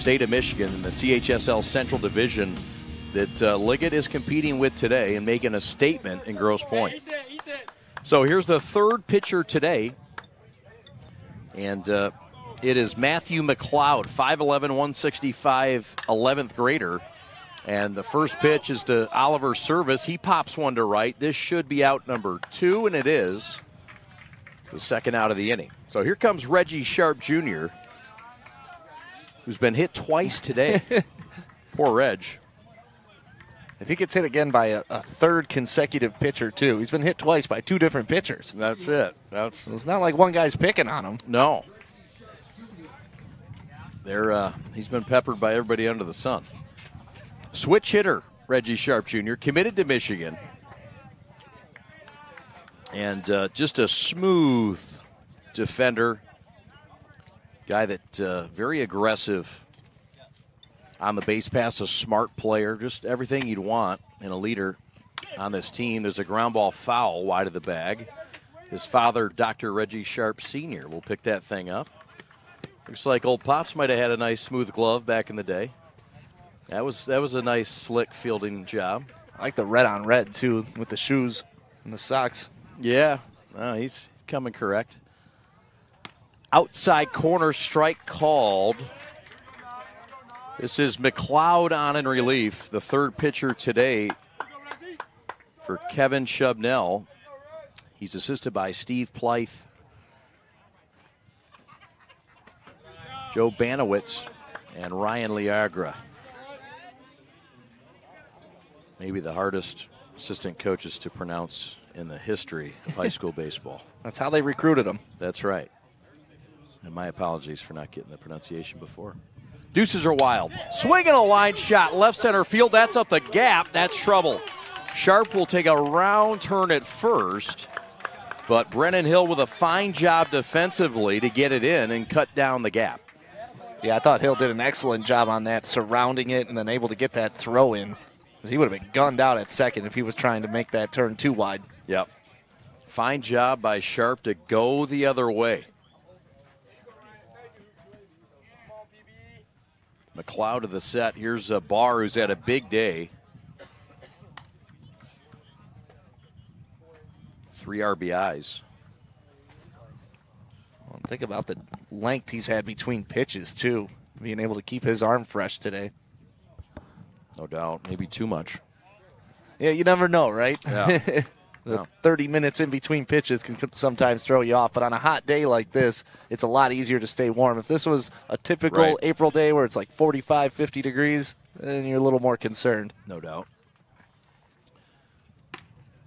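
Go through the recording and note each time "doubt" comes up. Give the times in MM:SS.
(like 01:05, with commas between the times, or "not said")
02:47, 03:03.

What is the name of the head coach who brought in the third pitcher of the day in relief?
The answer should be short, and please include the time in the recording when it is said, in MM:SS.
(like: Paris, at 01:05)
Kevin Shubnell, at 01:35.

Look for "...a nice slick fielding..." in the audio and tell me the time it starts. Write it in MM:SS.
01:17.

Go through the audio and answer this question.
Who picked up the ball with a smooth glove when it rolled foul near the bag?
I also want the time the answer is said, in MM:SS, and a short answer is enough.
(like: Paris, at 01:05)
Dr. Reggie Sharp Sr., at 01:09.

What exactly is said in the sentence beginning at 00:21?
This should be out number two, and it is.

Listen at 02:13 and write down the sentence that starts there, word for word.
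Yeah, I thought Hill did an excellent job on that, surrounding it and then able to get that throw in.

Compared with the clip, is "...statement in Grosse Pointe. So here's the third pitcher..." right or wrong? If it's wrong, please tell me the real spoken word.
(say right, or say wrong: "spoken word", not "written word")
right.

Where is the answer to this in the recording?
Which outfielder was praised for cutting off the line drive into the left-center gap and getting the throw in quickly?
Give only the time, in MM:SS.
02:08.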